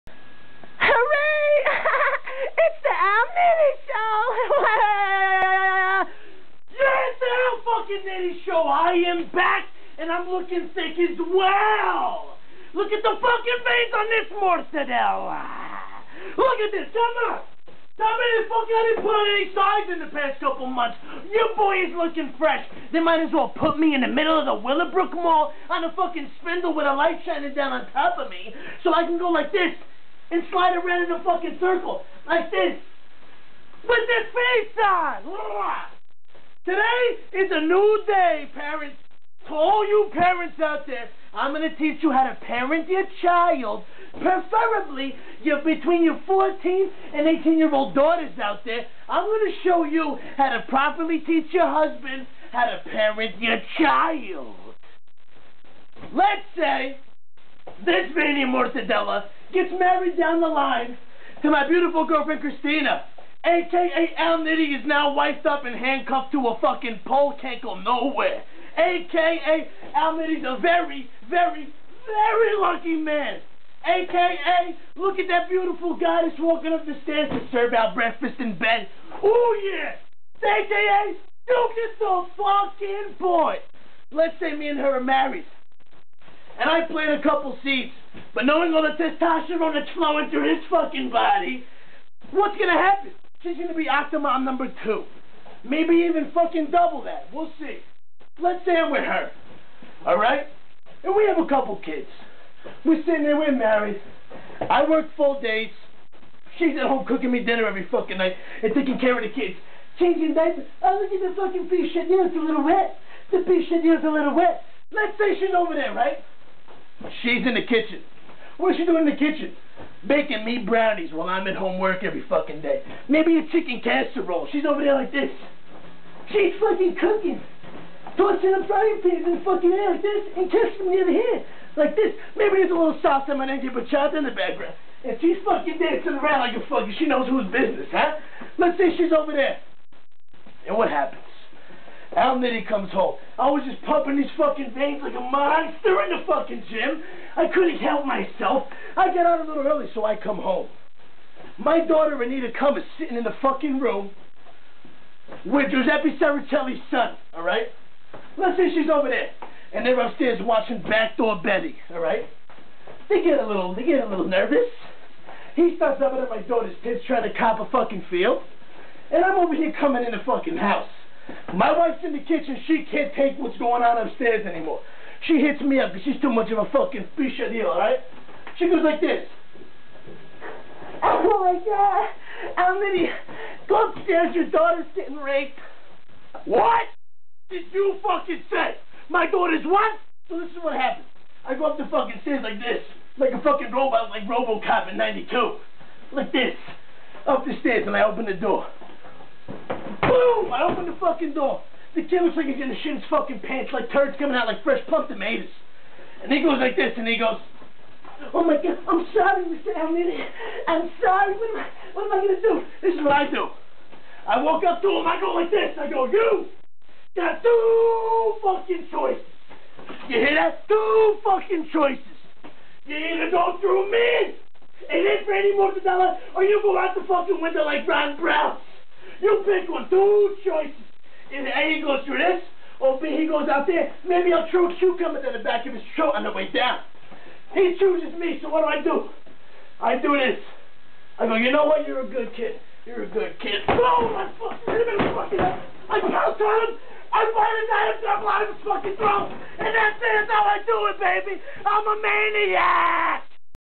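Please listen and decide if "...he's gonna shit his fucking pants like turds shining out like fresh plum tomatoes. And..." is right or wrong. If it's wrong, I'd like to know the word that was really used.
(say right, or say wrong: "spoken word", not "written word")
wrong: "coming", not "shining".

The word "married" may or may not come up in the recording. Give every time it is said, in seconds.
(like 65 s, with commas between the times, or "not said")
59 s, 85 s, 103 s.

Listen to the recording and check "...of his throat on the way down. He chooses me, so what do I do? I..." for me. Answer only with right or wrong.
right.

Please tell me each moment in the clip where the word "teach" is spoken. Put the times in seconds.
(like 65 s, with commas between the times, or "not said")
41 s, 51 s.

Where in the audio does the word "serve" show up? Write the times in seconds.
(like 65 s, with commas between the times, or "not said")
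77 s.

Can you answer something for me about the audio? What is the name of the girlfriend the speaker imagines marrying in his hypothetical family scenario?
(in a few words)
Christina.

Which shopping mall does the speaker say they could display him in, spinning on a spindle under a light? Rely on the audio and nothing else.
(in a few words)
Willowbrook Mall.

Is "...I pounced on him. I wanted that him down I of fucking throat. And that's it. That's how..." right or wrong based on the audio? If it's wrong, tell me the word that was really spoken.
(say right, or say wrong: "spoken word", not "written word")
right.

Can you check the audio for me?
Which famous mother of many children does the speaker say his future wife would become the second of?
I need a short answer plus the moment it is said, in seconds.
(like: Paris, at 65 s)
Octomom, at 93 s.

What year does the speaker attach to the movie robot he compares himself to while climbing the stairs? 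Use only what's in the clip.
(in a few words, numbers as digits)
92.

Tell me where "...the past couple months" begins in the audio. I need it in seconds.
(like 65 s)
20 s.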